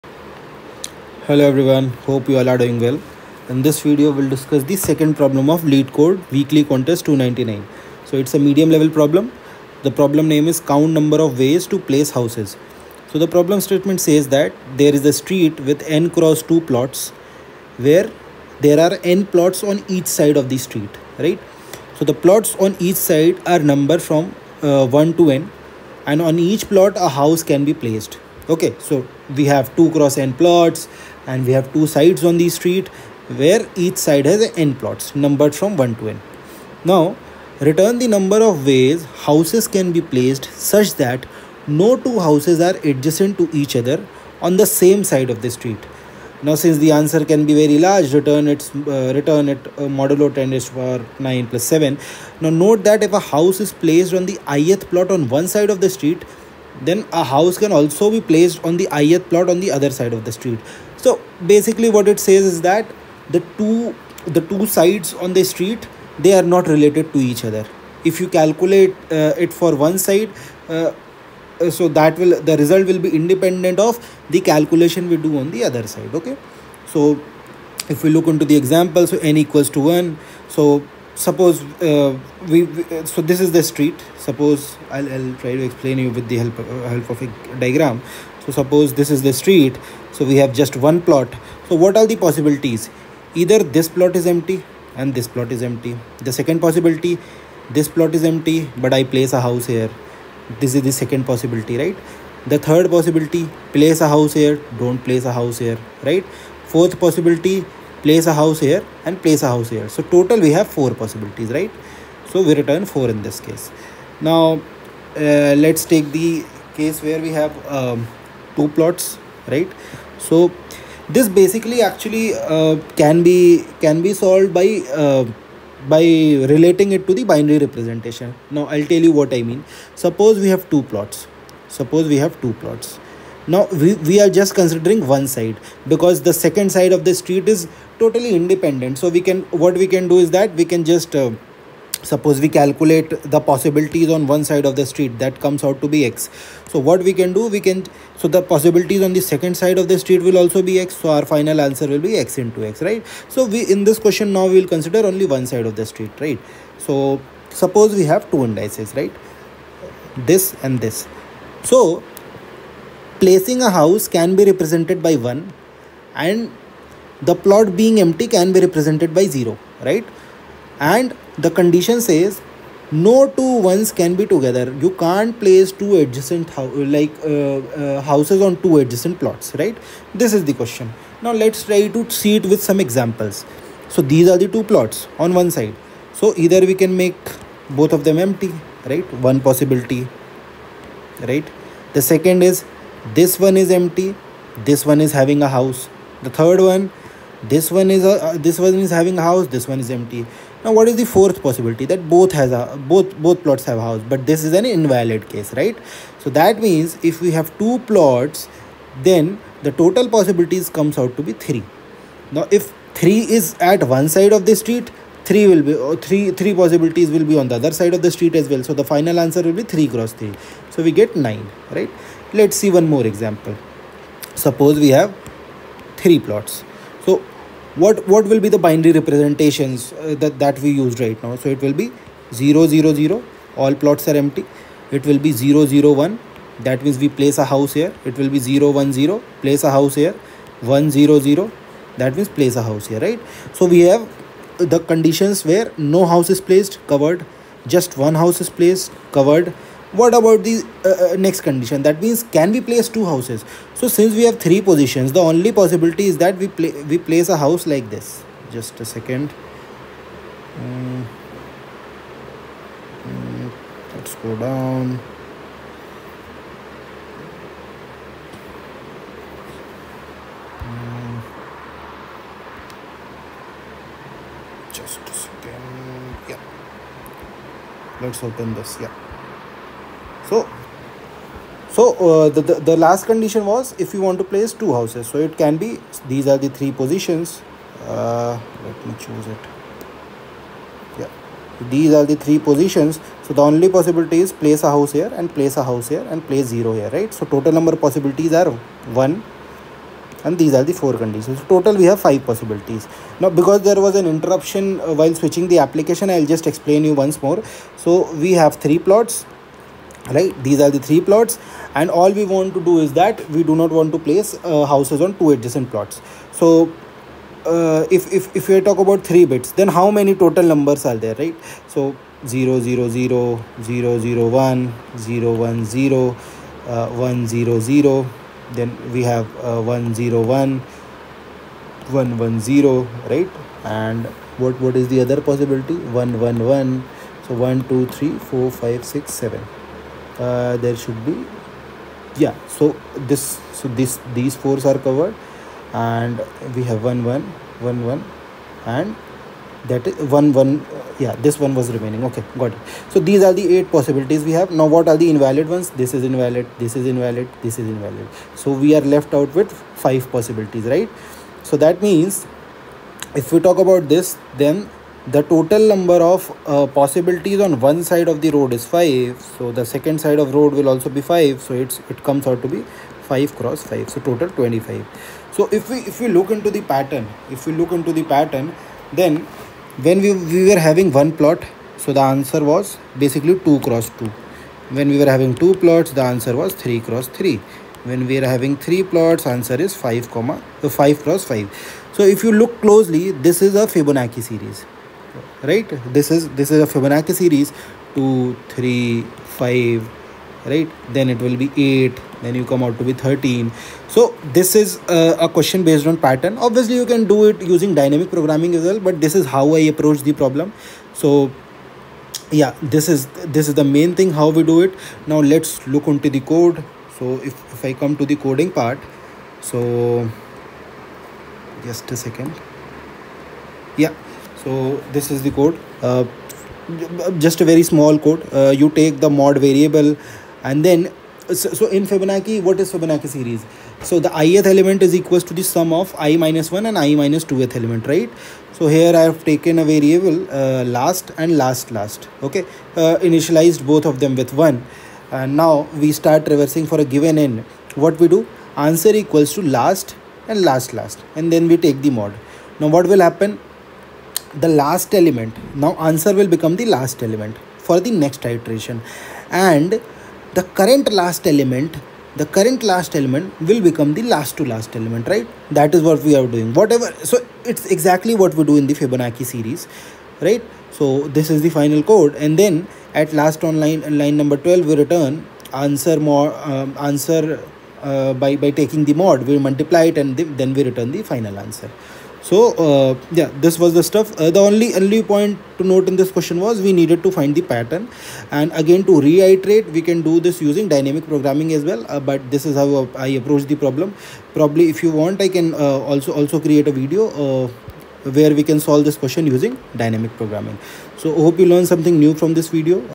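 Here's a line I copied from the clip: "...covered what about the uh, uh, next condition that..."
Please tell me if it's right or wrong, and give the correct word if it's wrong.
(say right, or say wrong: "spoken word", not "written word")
right.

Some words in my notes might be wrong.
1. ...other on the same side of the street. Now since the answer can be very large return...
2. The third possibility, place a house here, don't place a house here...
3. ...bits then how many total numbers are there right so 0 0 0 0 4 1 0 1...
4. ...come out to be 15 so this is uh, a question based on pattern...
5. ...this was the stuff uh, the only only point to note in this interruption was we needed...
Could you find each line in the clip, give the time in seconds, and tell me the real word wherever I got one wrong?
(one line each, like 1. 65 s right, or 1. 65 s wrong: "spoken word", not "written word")
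1. 43 s right
2. 102 s right
3. 319 s wrong: "0", not "4"
4. 402 s wrong: "13", not "15"
5. 483 s wrong: "question", not "interruption".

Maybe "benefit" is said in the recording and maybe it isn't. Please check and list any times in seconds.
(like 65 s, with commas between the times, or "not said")
not said.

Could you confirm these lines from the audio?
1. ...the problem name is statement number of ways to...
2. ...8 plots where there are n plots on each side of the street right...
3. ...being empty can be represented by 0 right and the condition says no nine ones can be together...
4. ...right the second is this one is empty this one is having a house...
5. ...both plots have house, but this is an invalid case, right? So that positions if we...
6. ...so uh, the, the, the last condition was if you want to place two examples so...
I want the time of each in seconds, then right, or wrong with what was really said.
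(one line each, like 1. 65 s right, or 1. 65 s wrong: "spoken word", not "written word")
1. 9 s wrong: "count", not "statement"
2. 16 s wrong: "2", not "8"
3. 167 s wrong: "two", not "nine"
4. 191 s right
5. 203 s wrong: "means", not "positions"
6. 281 s wrong: "houses", not "examples".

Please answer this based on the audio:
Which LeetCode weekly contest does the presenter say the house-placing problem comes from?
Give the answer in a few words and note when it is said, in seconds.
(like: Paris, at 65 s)
299, at 6 s.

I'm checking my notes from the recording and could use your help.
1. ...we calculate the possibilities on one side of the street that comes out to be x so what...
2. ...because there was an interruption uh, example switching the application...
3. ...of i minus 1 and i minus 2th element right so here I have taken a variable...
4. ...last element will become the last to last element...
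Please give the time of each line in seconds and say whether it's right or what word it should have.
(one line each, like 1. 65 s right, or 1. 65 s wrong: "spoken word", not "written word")
1. 142 s right
2. 303 s wrong: "while", not "example"
3. 435 s right
4. 462 s right.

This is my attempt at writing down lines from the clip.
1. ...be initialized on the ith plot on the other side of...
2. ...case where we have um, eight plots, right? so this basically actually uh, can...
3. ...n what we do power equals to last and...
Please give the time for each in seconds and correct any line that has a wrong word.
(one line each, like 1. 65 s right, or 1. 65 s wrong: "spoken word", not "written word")
1. 58 s wrong: "placed", not "initialized"
2. 116 s wrong: "two", not "eight"
3. 447 s wrong: "answer", not "power".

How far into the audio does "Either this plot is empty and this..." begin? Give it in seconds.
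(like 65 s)
93 s.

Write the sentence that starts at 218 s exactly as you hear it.
So the final answer will be three cross three.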